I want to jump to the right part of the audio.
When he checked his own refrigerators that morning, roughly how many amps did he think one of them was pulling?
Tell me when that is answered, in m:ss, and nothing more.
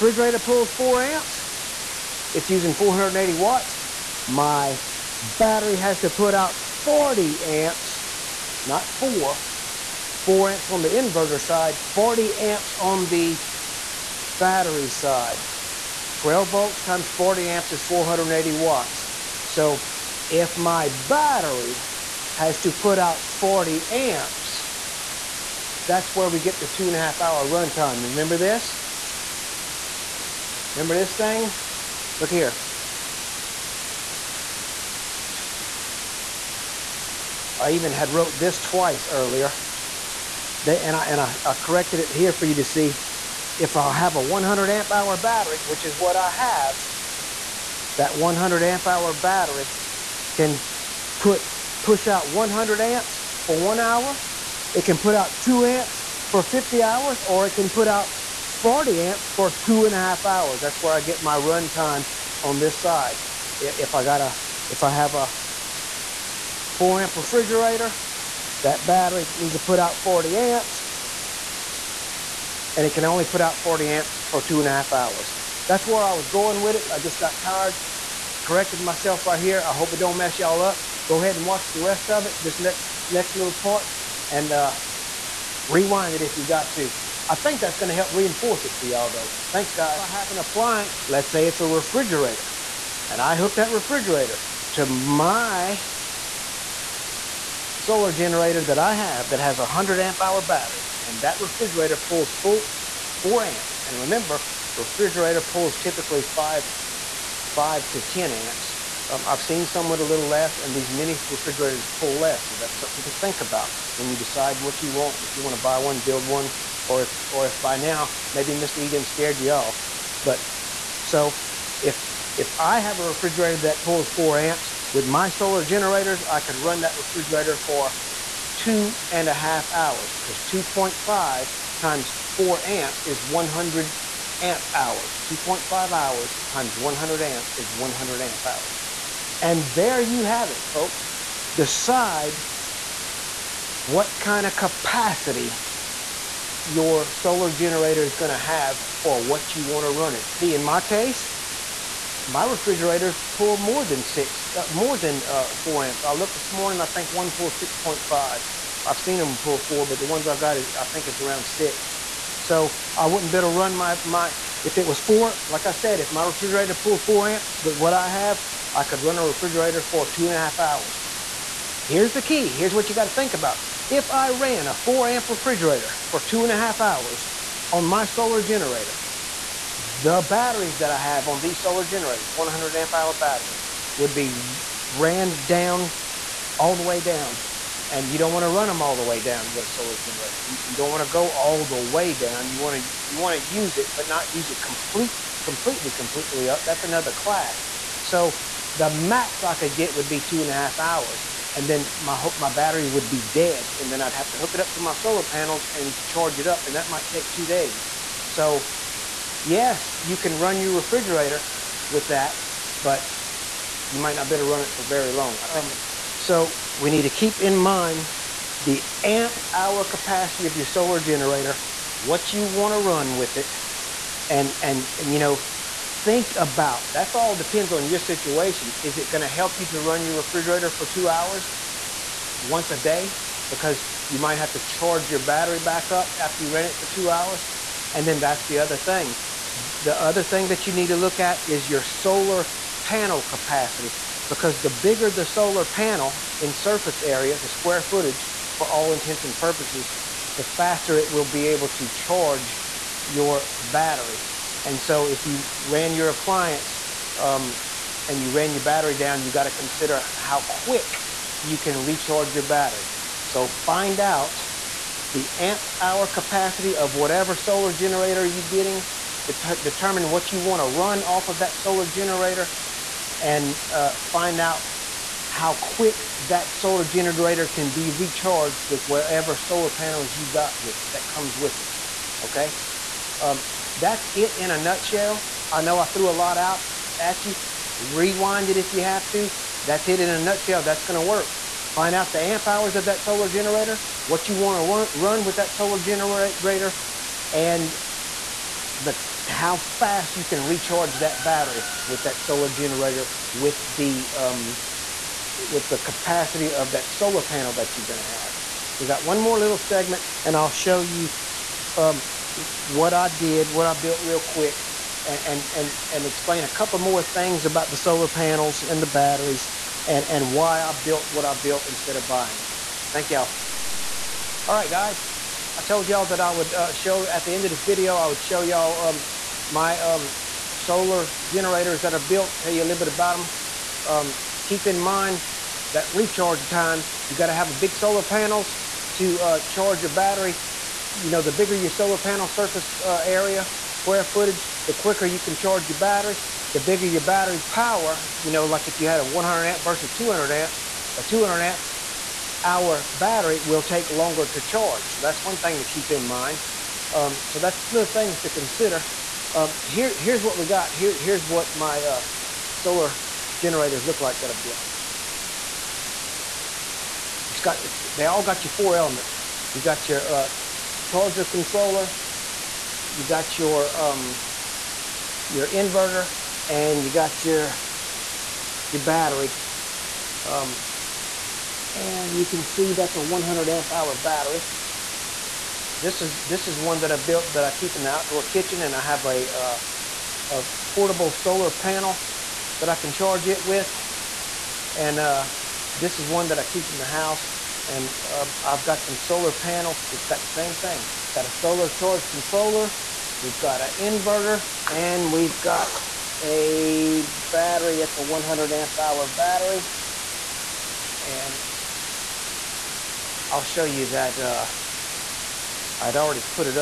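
2:37.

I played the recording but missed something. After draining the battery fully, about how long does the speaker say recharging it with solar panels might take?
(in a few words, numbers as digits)
2 days.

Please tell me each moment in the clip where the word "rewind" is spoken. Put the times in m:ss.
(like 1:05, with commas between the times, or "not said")
1:25, 4:47.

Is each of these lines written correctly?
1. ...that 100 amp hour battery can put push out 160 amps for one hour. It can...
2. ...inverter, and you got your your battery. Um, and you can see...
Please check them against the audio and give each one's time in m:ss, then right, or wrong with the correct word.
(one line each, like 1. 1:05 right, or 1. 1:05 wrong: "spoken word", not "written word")
1. 0:47 wrong: "100", not "160"
2. 6:15 right.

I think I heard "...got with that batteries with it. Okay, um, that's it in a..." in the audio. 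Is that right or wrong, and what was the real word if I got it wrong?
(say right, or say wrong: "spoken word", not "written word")
wrong: "comes", not "batteries".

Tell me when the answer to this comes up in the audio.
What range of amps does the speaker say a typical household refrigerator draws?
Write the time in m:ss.
1:47.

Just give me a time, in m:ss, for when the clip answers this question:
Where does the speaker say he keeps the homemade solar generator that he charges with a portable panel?
6:27.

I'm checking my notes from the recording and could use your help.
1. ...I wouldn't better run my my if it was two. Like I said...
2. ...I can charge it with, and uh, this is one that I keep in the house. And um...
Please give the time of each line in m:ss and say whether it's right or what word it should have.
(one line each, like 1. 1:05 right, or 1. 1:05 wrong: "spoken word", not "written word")
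1. 2:42 wrong: "four", not "two"
2. 6:32 right.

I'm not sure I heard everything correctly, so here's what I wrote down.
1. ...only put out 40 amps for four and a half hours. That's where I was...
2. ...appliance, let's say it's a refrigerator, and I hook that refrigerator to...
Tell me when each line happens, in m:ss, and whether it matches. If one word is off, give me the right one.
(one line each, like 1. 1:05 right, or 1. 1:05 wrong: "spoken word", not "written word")
1. 1:13 wrong: "two", not "four"
2. 1:30 right.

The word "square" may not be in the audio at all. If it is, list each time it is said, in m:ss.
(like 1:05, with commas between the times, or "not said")
4:07, 5:43.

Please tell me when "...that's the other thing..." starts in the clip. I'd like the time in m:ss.
3:58.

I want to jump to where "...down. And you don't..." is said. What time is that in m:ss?
3:07.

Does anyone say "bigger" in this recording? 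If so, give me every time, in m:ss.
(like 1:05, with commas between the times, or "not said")
4:04, 5:41, 5:46.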